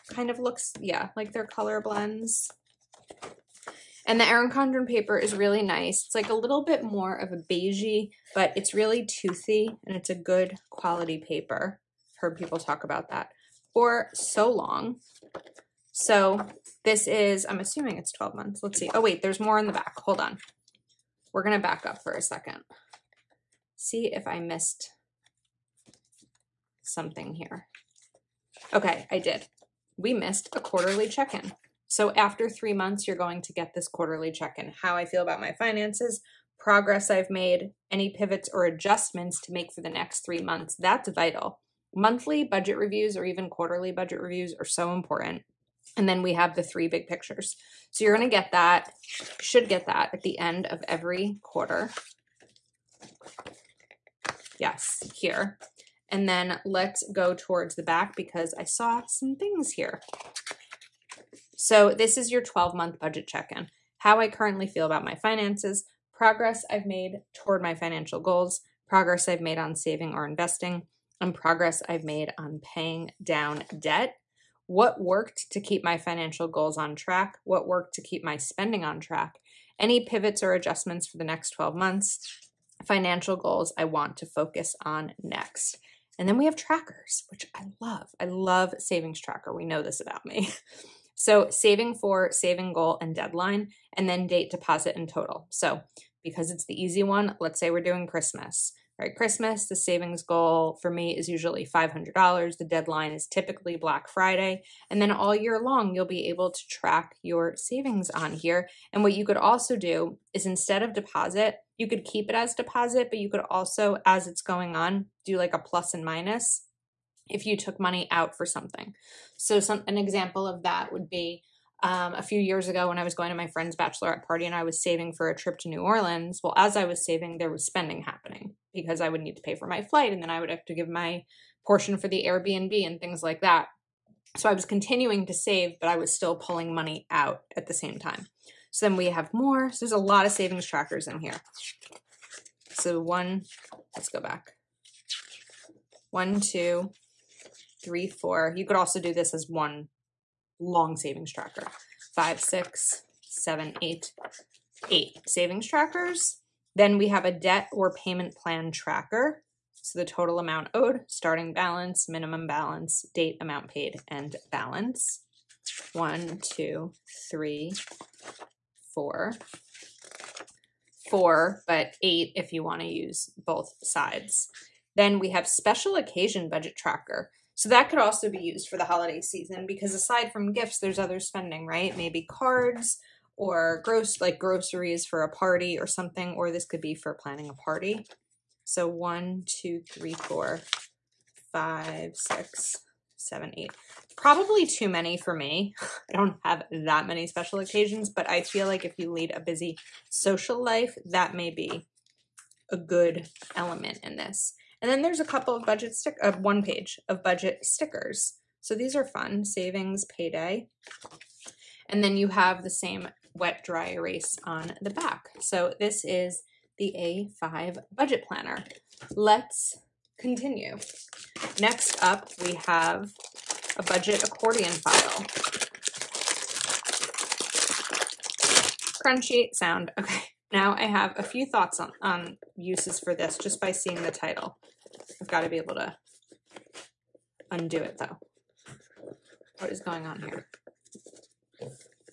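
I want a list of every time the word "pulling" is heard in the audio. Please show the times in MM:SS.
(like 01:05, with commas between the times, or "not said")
02:16.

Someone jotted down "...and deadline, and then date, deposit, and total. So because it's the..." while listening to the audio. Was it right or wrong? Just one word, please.
right.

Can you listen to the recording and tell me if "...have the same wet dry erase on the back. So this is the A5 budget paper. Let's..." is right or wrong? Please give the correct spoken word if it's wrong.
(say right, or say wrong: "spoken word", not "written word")
wrong: "planner", not "paper".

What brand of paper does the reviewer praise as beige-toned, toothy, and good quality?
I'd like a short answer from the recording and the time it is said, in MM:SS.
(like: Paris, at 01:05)
Erin Condren, at 00:04.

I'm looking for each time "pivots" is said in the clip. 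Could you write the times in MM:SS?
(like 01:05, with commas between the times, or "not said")
00:38, 01:20.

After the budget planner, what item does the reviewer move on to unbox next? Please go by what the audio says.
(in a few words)
budget accordion file.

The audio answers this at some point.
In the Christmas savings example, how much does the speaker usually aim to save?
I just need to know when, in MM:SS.
01:41.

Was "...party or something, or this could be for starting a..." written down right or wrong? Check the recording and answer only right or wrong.
wrong.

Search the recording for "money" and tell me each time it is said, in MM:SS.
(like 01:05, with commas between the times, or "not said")
01:57, 02:16.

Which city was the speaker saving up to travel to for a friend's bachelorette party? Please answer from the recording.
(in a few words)
New Orleans.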